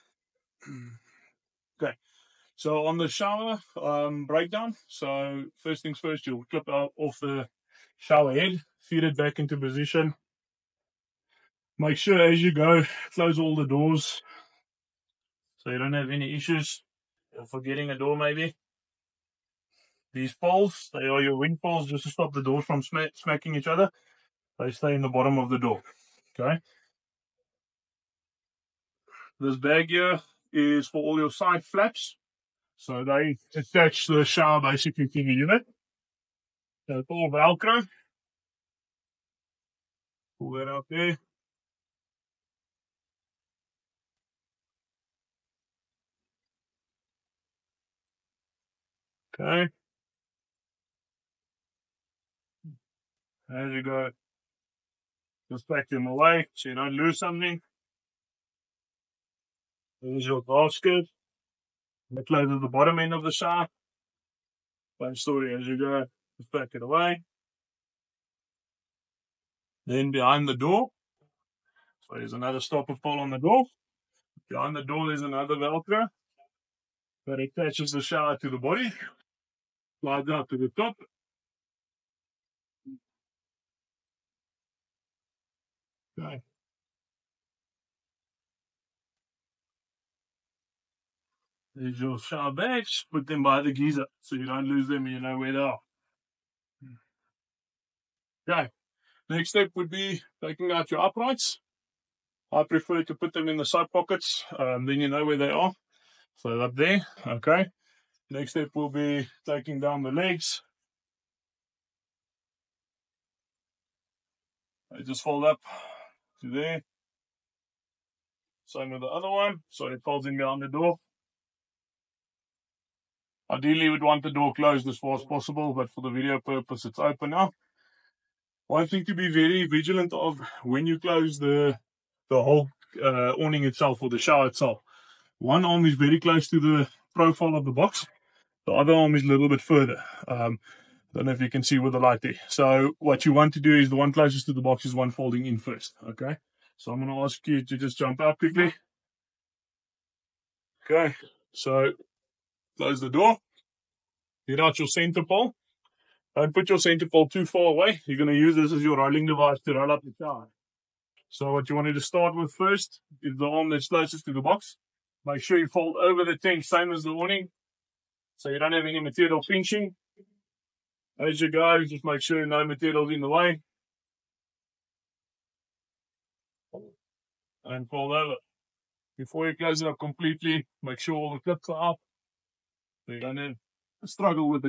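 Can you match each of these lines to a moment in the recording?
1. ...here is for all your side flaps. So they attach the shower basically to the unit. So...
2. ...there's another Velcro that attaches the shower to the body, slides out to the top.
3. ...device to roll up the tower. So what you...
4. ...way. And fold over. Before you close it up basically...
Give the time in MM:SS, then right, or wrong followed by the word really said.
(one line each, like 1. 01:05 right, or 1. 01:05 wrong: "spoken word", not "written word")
1. 00:29 right
2. 01:15 right
3. 02:39 right
4. 02:53 wrong: "completely", not "basically".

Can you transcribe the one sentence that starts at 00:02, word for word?
So on the shower um, breakdown, so first things first, you'll clip out off the shower head, feed it back into position.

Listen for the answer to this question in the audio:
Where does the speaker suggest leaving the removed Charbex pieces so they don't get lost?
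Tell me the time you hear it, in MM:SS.
01:33.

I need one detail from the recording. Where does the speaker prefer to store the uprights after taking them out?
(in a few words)
Side pockets.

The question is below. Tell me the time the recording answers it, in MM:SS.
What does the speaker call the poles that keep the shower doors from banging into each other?
00:21.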